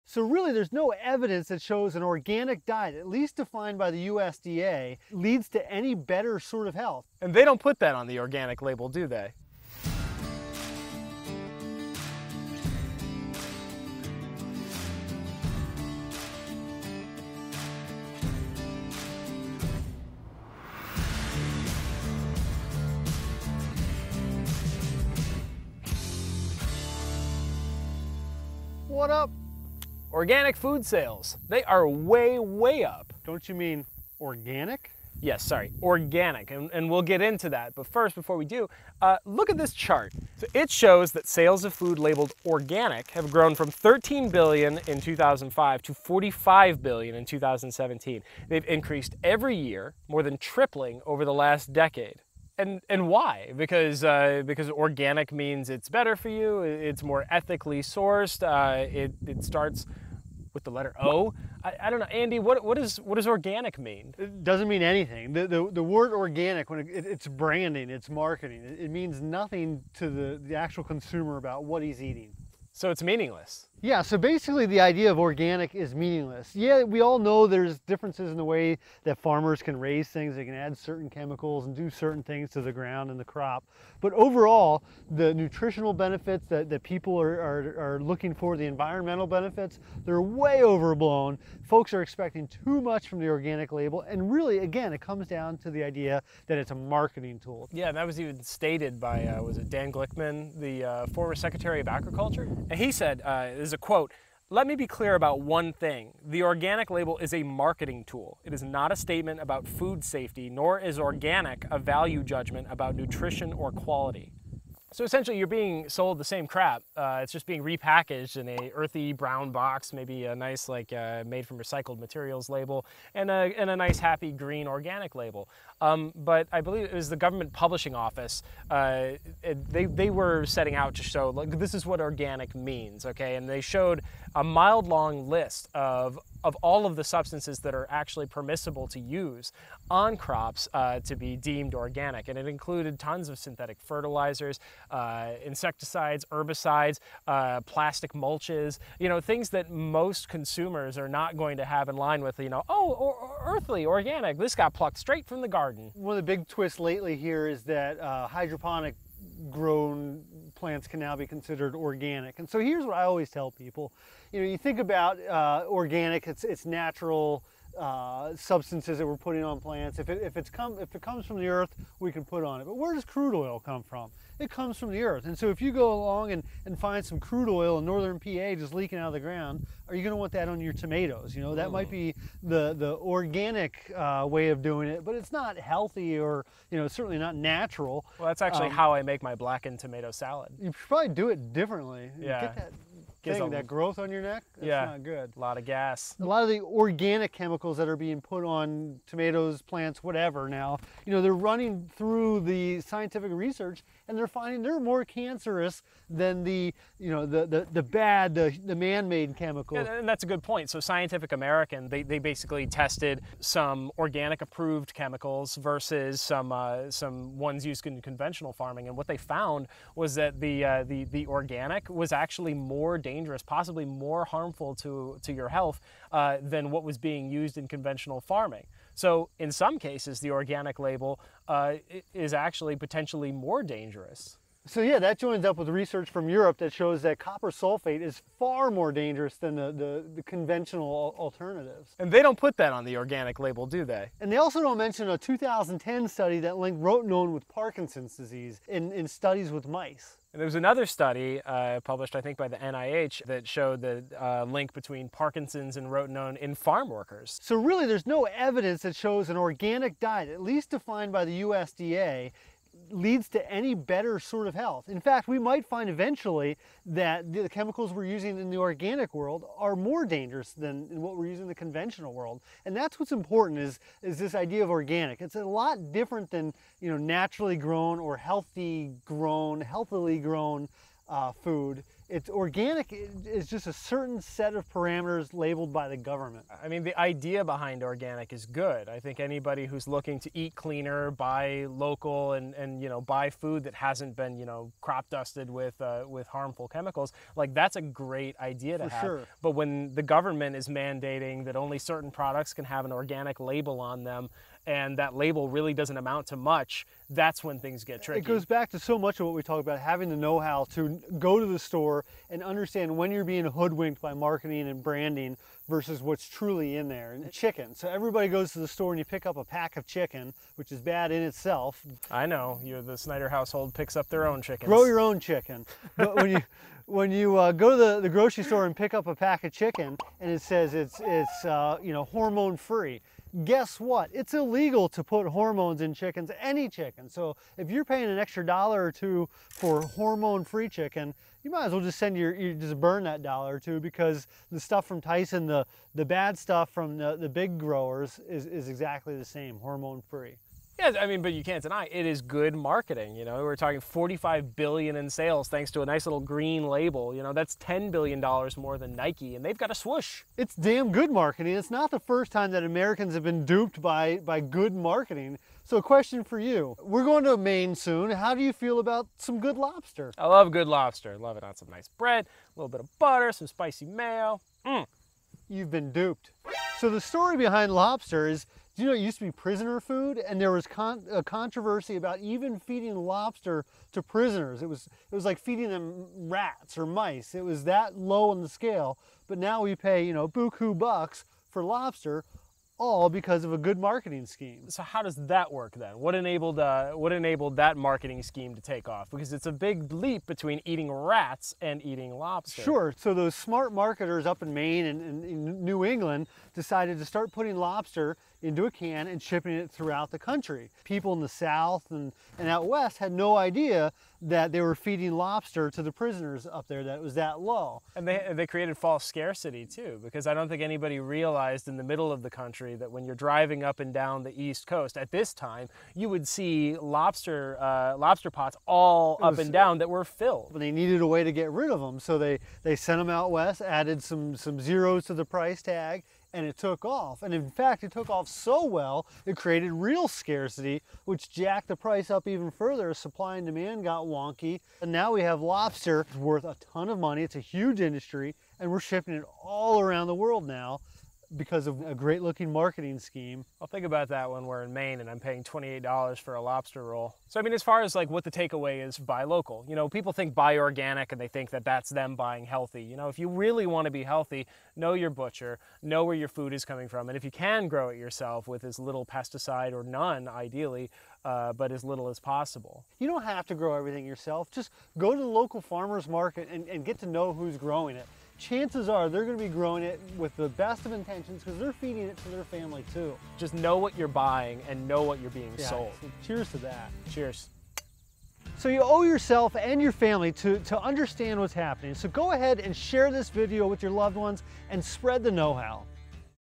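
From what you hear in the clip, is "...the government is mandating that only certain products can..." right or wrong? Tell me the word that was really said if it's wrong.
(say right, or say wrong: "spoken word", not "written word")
right.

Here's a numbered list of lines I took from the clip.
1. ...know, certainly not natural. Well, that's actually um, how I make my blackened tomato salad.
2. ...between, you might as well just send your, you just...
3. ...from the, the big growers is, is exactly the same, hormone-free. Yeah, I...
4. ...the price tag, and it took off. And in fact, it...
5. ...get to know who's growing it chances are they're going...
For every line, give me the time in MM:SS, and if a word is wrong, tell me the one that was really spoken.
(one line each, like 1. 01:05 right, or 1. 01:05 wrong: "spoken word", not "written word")
1. 03:06 right
2. 05:40 wrong: "chicken", not "between"
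3. 05:46 right
4. 07:15 right
5. 07:56 right.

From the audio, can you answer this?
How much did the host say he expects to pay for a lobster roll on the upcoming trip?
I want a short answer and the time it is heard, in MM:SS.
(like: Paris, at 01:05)
$28, at 07:35.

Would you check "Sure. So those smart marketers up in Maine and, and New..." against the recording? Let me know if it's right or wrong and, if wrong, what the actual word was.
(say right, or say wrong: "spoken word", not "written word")
right.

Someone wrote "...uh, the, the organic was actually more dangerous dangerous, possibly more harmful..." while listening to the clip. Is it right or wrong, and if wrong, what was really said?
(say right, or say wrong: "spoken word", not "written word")
right.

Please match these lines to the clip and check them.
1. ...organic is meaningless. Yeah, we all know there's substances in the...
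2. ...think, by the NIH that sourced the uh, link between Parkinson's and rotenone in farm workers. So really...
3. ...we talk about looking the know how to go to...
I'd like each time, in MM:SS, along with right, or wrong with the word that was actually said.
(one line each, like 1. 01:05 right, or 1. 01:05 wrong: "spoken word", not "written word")
1. 01:15 wrong: "differences", not "substances"
2. 04:12 wrong: "showed", not "sourced"
3. 05:09 wrong: "having", not "looking".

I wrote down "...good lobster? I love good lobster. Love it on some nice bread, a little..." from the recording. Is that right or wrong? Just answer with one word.
right.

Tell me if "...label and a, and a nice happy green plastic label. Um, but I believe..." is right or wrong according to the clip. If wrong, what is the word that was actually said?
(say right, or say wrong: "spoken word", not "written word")
wrong: "organic", not "plastic".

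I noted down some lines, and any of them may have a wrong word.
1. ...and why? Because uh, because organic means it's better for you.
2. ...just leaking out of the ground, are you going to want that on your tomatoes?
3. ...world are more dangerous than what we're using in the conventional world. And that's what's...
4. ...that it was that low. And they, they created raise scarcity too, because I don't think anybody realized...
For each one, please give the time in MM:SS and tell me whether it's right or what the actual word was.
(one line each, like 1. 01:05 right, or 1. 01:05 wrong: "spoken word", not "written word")
1. 00:52 right
2. 02:58 right
3. 04:29 right
4. 06:56 wrong: "false", not "raise".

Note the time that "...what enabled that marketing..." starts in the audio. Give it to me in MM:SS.
06:36.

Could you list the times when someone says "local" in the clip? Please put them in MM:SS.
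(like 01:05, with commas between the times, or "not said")
04:51, 07:39, 07:55.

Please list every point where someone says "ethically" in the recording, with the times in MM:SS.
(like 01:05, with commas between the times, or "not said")
00:57.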